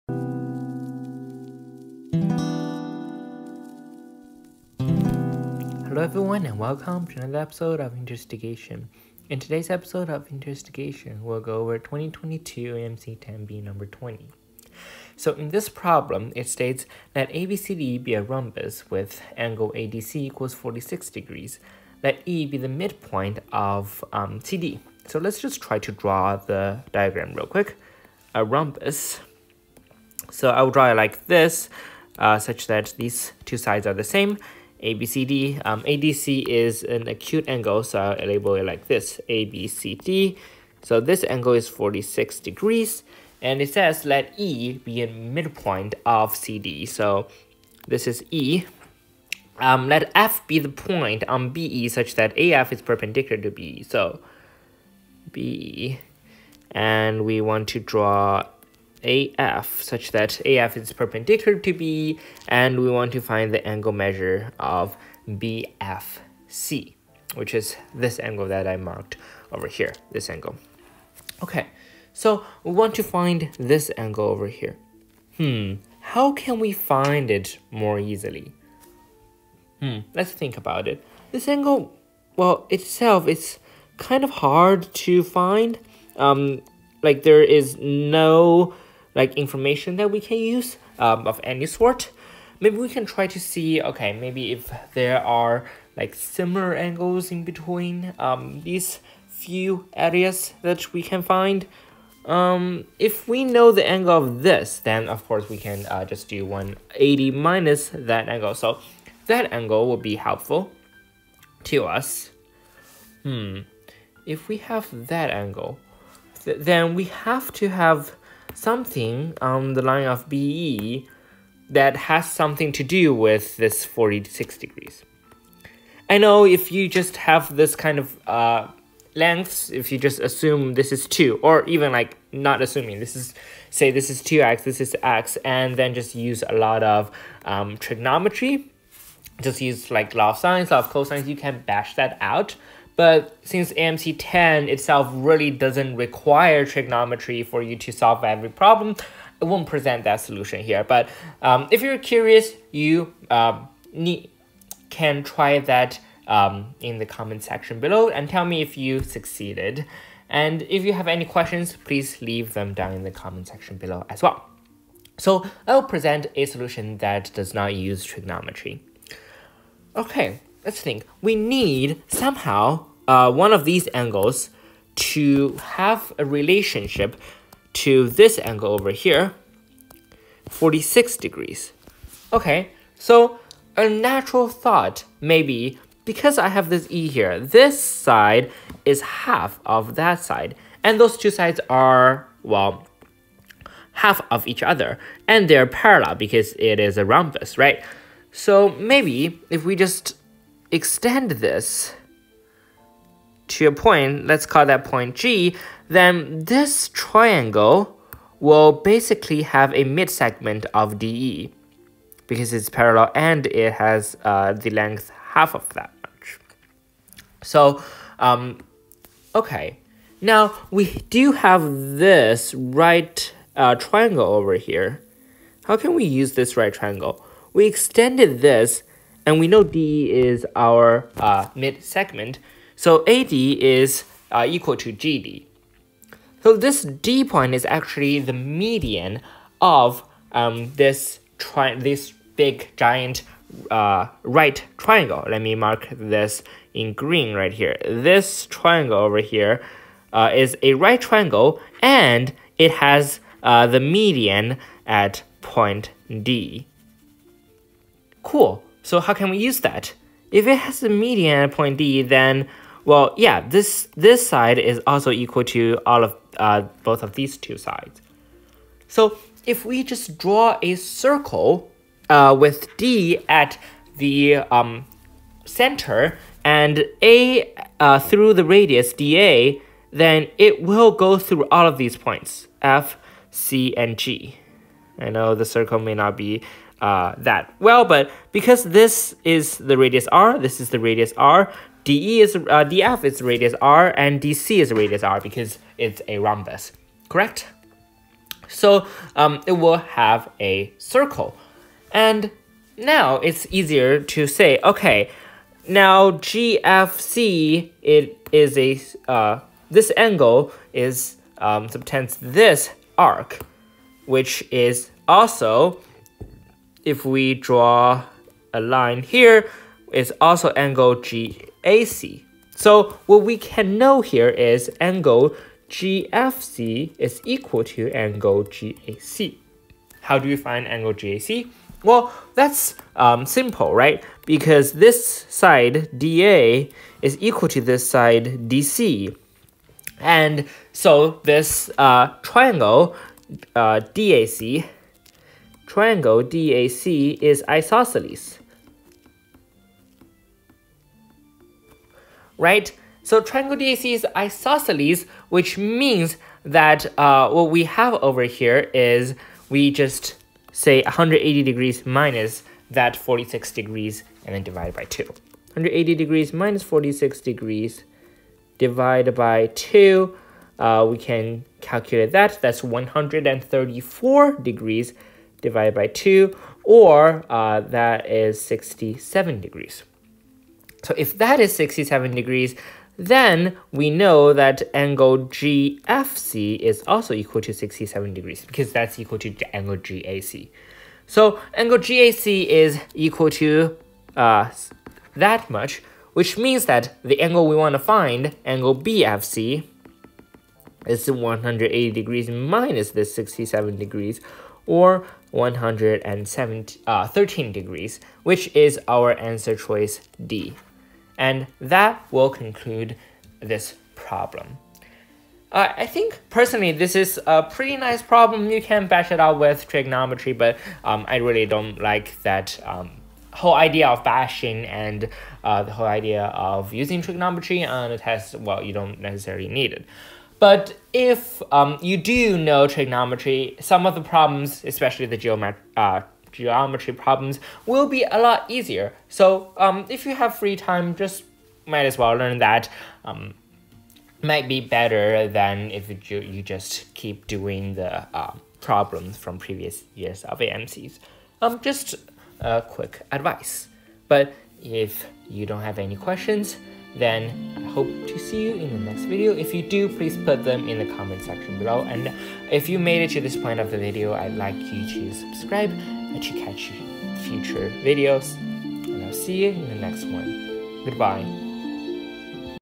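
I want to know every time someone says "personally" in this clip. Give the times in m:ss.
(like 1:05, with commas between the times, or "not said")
6:56.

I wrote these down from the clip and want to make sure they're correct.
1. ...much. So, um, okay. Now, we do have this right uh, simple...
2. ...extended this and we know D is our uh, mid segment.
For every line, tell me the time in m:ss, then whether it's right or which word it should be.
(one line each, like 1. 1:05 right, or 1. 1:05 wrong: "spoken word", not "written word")
1. 3:36 wrong: "triangle", not "simple"
2. 3:47 right.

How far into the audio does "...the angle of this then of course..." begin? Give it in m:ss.
1:43.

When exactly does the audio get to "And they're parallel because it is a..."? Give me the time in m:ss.
3:15.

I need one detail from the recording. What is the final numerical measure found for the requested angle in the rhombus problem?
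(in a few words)
113 degrees.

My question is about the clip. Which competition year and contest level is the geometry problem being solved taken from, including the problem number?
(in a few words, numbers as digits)
2022 AMC 10B number 20.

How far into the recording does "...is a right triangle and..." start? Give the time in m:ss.
4:10.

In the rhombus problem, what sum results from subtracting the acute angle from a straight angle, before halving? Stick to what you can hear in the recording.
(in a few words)
134 degrees.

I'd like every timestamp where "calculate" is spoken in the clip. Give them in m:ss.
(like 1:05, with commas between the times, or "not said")
6:11.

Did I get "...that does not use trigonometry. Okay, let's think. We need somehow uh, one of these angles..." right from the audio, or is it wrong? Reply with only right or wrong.
right.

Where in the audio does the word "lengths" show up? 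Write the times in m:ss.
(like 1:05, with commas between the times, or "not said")
2:09, 3:34.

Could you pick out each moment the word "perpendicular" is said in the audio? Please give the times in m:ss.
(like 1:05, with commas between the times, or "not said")
0:52, 1:00.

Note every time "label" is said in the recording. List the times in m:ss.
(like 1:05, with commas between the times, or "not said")
0:38.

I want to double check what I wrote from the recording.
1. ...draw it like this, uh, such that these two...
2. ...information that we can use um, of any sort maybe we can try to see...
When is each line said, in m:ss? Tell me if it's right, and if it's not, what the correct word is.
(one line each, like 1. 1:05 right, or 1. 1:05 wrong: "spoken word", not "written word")
1. 0:30 right
2. 1:29 right.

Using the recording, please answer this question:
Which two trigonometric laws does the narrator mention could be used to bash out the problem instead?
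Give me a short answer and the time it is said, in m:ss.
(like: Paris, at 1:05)
law of sines, law of cosines, at 2:20.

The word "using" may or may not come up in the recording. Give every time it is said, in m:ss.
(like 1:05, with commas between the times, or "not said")
7:06.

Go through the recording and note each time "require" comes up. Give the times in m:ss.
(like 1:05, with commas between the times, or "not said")
2:25.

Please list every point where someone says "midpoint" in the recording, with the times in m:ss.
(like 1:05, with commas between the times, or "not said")
0:22, 0:45.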